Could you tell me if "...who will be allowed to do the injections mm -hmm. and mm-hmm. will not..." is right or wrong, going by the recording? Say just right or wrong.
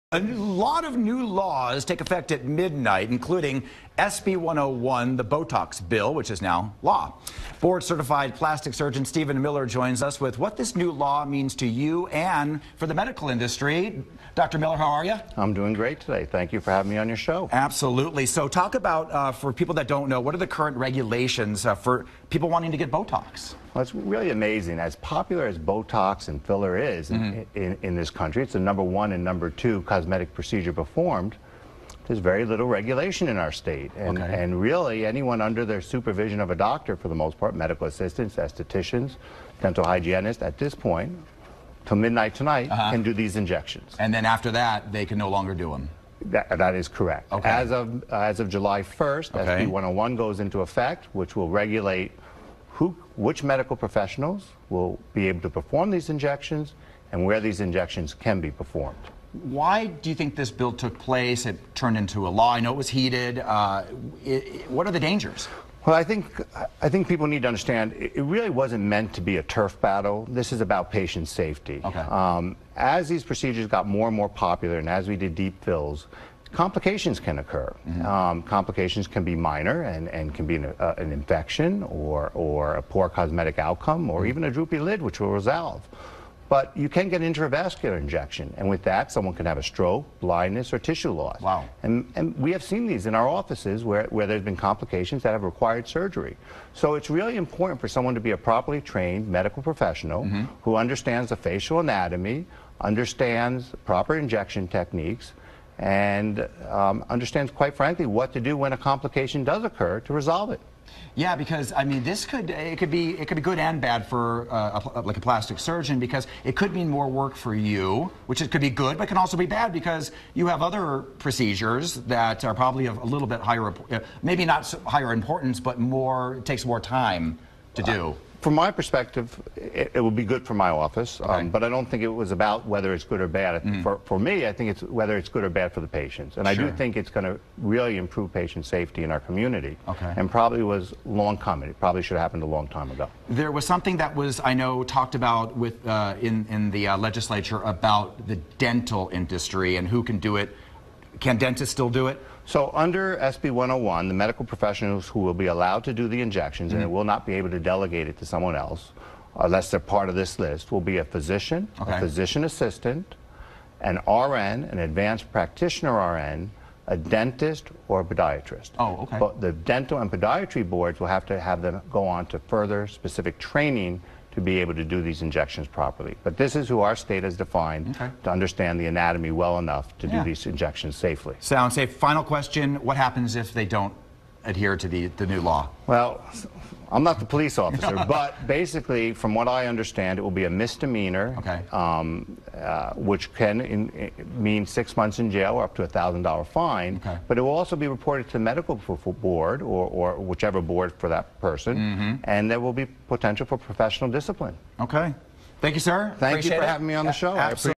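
right.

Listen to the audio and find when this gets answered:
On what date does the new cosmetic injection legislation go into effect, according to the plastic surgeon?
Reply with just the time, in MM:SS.
00:48.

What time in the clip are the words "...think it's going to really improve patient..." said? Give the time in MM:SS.
02:16.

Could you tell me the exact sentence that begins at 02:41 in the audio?
a physician assistant, an RN, an advanced practitioner RN, a dentist or a podiatrist.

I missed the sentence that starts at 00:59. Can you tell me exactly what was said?
Why do you think this bill took place?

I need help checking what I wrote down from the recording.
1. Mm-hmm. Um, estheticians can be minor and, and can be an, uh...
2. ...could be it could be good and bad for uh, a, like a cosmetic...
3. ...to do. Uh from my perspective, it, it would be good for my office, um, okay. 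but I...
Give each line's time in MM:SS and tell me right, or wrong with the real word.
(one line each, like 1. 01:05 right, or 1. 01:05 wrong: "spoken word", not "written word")
1. 01:17 wrong: "complications", not "estheticians"
2. 01:52 wrong: "plastic", not "cosmetic"
3. 02:07 right.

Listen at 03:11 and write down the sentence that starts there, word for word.
um, uh, which can in, eh, mean six months in jail or up to a $1,000 fine.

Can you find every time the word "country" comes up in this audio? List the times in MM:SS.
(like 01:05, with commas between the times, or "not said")
00:28.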